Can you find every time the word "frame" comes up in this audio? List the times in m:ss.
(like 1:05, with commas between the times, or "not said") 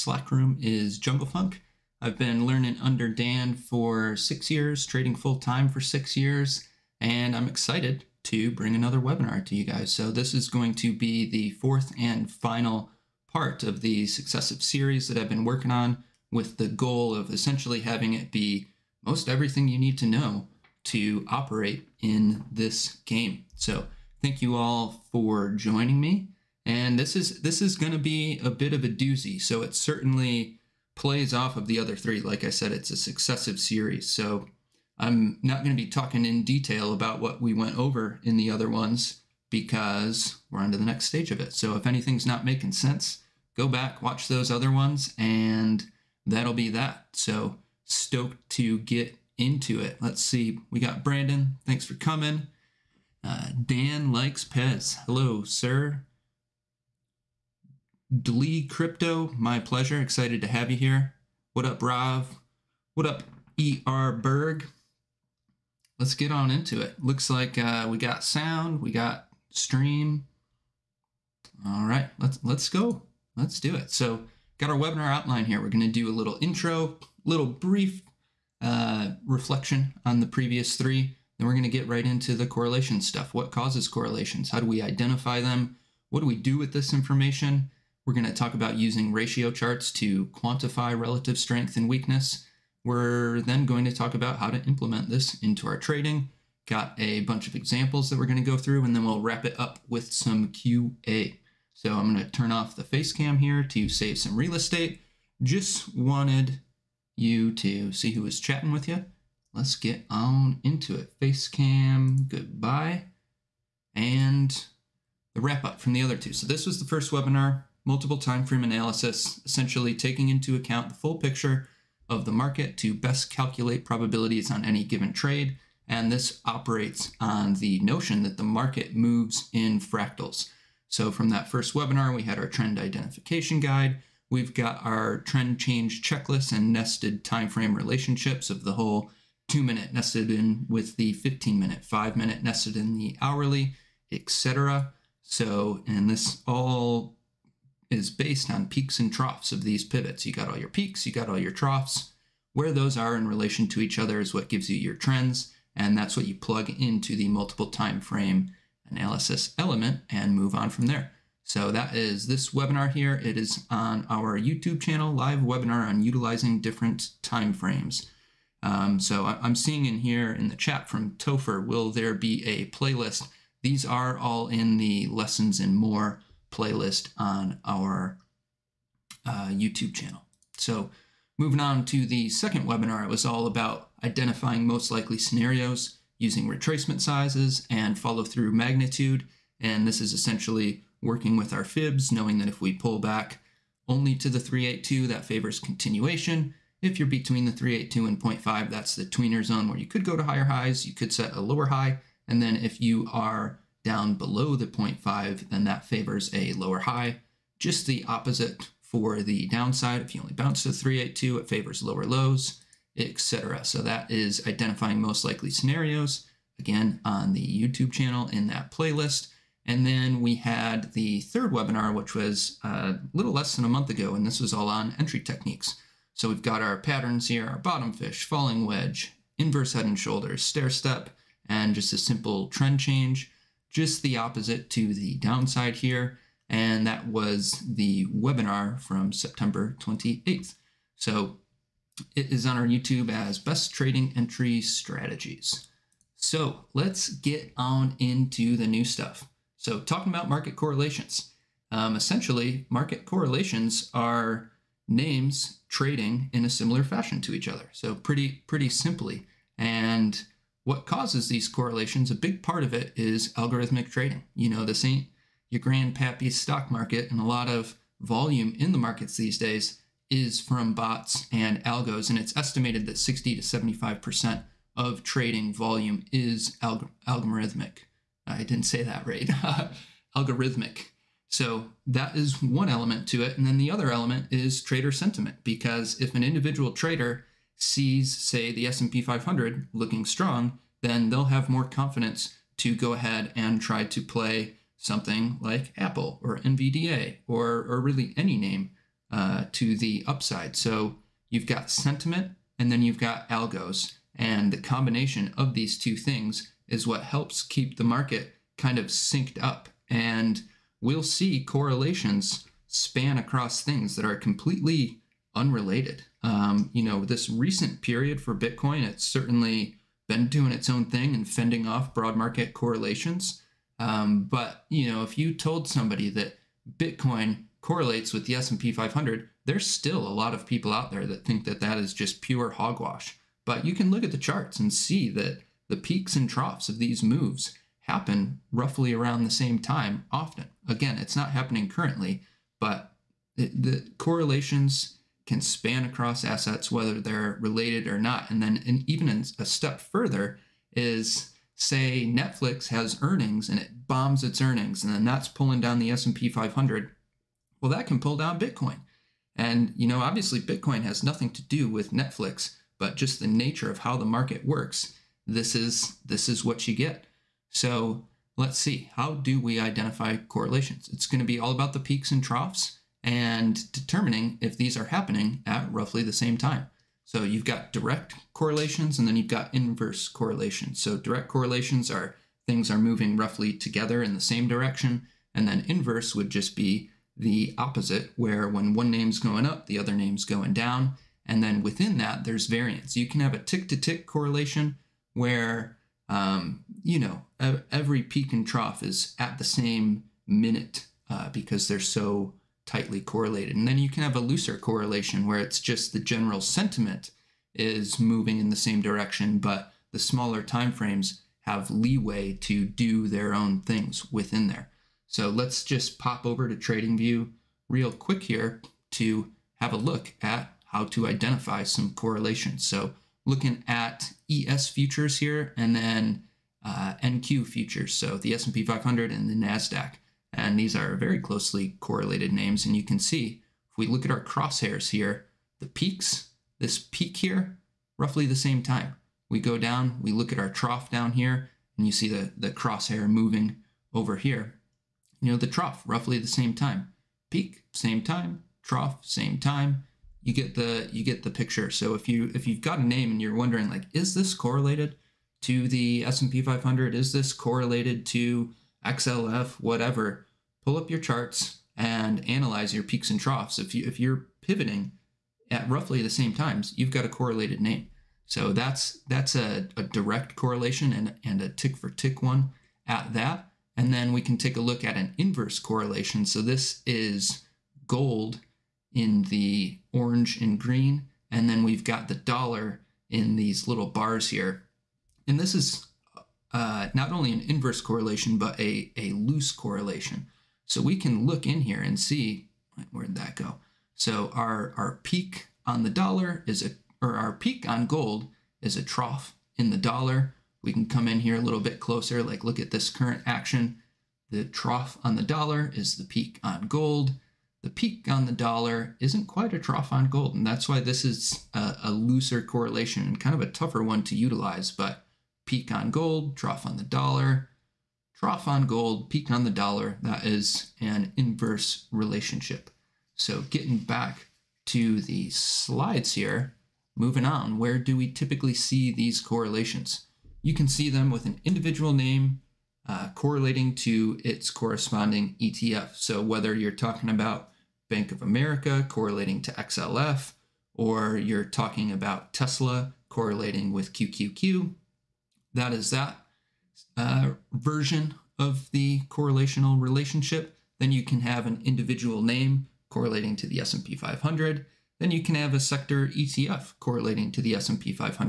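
1:58, 2:17, 2:37, 2:47, 6:50.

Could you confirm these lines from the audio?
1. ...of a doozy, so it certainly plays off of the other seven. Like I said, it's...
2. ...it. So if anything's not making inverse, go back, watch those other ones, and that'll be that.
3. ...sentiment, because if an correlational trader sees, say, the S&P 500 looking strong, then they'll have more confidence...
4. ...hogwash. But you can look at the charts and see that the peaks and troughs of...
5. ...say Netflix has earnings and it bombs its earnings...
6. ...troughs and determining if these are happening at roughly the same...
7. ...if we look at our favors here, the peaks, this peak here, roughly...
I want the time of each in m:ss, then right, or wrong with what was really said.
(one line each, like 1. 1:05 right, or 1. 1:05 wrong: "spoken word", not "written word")
1. 0:28 wrong: "three", not "seven"
2. 0:41 wrong: "sense", not "inverse"
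3. 4:44 wrong: "individual", not "correlational"
4. 5:32 right
5. 5:51 right
6. 6:12 right
7. 7:13 wrong: "crosshairs", not "favors".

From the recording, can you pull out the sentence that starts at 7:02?
So looking at ES futures here and then uh, NQ futures, so the S&P 500 and the Nasdaq.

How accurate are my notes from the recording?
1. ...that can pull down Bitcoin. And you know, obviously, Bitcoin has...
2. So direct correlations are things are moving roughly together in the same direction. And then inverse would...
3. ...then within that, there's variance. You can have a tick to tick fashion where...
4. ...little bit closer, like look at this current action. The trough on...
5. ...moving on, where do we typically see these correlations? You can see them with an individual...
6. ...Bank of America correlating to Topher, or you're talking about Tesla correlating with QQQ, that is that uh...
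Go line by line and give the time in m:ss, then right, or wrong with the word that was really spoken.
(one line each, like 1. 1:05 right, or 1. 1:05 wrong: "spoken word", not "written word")
1. 5:57 right
2. 6:20 right
3. 6:31 wrong: "correlation", not "fashion"
4. 8:21 right
5. 8:46 right
6. 8:57 wrong: "XLF", not "Topher".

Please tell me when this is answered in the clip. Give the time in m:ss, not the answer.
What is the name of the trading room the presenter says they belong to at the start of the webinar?
0:00.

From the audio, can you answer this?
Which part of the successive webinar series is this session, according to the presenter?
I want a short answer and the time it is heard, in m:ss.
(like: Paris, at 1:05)
Fourth, at 0:11.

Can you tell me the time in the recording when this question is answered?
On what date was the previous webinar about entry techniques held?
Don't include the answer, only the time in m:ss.
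3:59.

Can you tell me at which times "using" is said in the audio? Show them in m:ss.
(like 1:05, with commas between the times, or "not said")
1:28, 3:06.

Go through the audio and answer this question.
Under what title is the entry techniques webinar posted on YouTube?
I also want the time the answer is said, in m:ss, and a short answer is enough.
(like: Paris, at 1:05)
Best Trading Entry Strategies, at 4:03.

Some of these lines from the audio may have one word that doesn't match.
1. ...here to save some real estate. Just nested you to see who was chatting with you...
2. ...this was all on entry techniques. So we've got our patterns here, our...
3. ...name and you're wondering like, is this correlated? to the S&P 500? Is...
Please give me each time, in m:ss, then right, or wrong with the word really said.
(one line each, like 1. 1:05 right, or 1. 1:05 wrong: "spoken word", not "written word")
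1. 1:43 wrong: "wanted", not "nested"
2. 3:44 right
3. 7:32 right.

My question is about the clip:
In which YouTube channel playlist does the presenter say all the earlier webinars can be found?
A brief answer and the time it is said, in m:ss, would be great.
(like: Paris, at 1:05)
Lessons and more, at 2:55.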